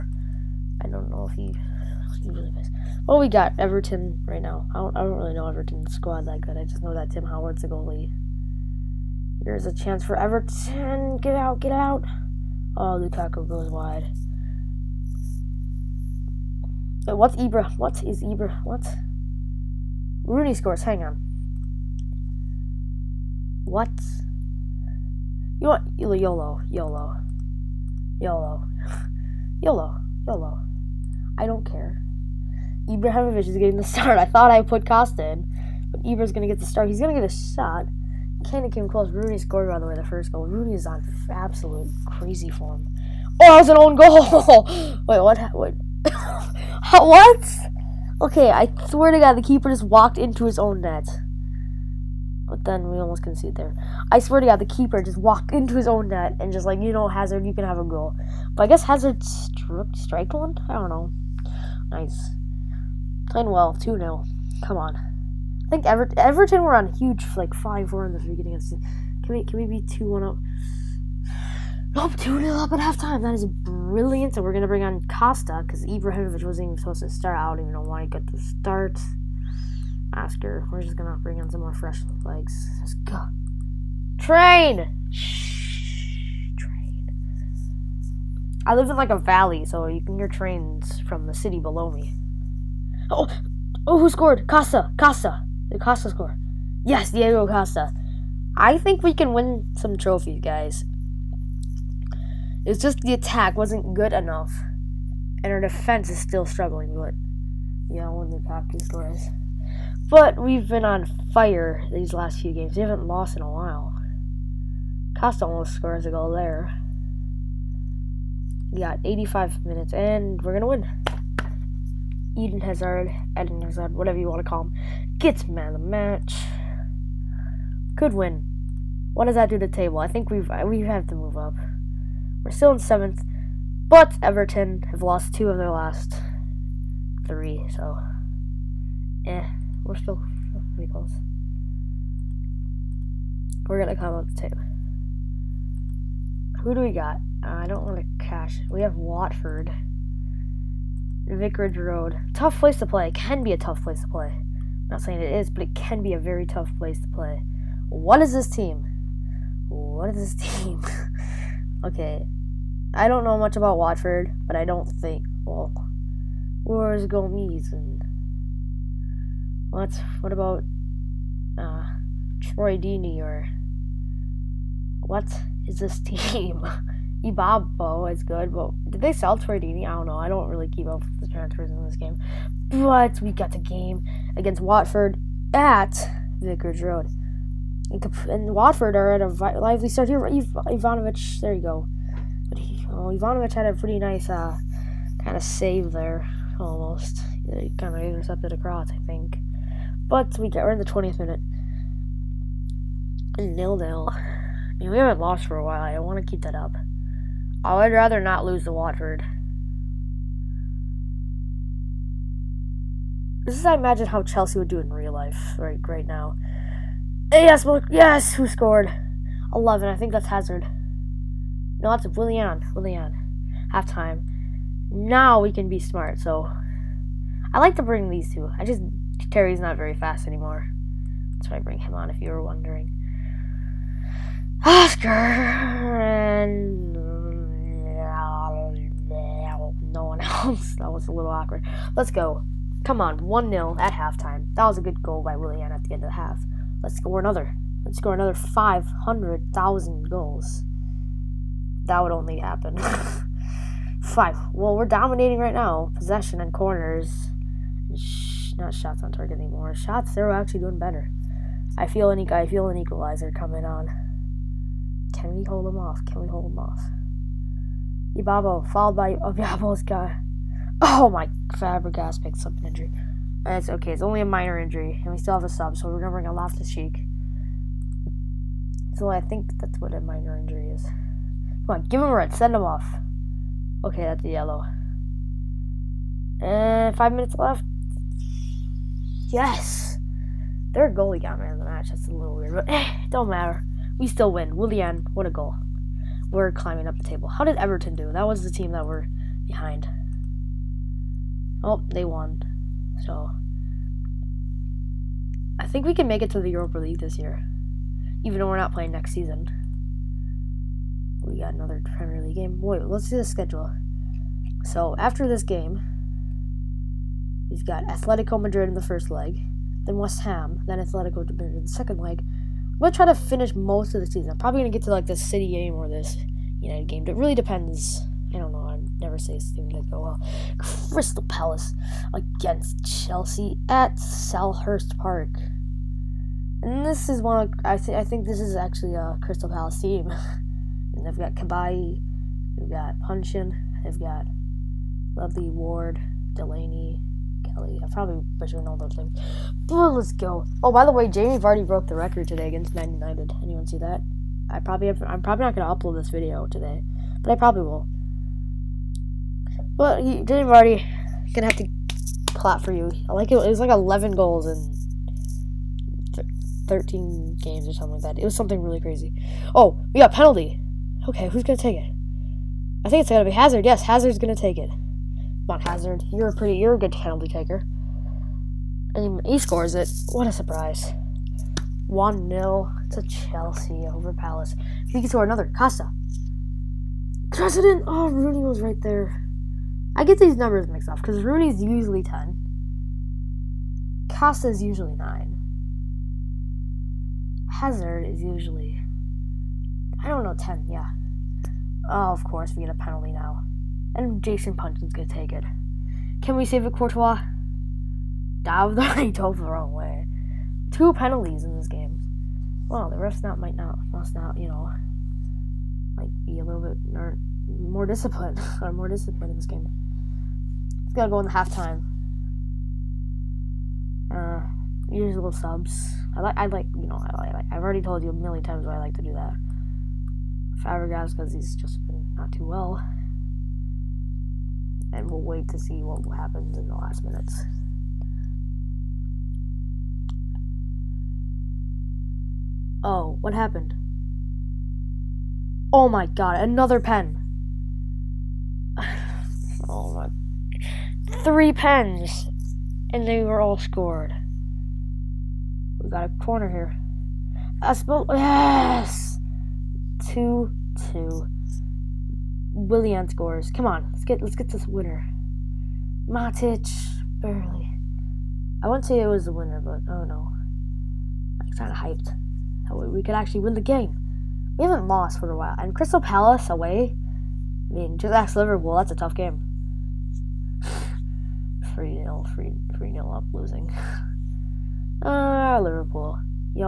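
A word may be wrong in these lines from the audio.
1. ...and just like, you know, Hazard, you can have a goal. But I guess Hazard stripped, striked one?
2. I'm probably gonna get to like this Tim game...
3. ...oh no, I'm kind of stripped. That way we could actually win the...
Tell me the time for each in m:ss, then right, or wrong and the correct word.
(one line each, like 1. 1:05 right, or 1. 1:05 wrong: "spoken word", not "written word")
1. 0:56 right
2. 5:24 wrong: "City", not "Tim"
3. 7:49 wrong: "hyped", not "stripped".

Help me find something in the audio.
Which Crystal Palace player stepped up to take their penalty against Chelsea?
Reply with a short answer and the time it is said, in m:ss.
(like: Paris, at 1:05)
Jason Puncheon, at 6:44.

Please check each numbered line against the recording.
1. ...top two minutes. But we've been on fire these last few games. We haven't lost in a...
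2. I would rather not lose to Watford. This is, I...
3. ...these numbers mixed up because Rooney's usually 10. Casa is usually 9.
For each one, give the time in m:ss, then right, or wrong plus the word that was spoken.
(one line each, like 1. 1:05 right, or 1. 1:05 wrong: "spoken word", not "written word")
1. 1:48 wrong: "scores", not "minutes"
2. 3:27 right
3. 6:30 right.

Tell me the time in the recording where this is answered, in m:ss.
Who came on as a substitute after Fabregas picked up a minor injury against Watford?
4:36.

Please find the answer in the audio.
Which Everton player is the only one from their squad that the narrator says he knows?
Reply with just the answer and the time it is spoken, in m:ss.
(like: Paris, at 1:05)
Tim Howard, at 0:07.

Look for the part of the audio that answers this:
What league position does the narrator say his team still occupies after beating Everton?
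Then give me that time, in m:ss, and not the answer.
2:12.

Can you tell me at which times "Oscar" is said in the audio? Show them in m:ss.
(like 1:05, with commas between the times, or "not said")
1:20, 3:54.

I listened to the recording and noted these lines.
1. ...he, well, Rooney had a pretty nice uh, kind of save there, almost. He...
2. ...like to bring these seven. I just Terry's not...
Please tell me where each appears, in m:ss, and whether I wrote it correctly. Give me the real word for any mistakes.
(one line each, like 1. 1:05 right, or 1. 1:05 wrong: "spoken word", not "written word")
1. 3:12 wrong: "Ivanovic", not "Rooney"
2. 3:47 wrong: "two", not "seven".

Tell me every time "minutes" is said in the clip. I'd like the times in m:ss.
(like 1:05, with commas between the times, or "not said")
1:59, 3:21, 4:47, 7:17.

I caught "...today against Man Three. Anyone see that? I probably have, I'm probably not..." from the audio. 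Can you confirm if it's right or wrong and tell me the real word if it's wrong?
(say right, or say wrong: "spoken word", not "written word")
wrong: "United", not "Three".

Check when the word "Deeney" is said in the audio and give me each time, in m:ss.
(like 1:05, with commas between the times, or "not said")
2:52, 2:59.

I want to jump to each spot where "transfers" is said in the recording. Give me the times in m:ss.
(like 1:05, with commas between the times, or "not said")
3:01.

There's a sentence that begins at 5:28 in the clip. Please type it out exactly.
I never say things like that.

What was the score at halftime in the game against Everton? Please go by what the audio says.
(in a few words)
2-0.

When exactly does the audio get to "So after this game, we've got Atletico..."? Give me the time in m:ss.
5:14.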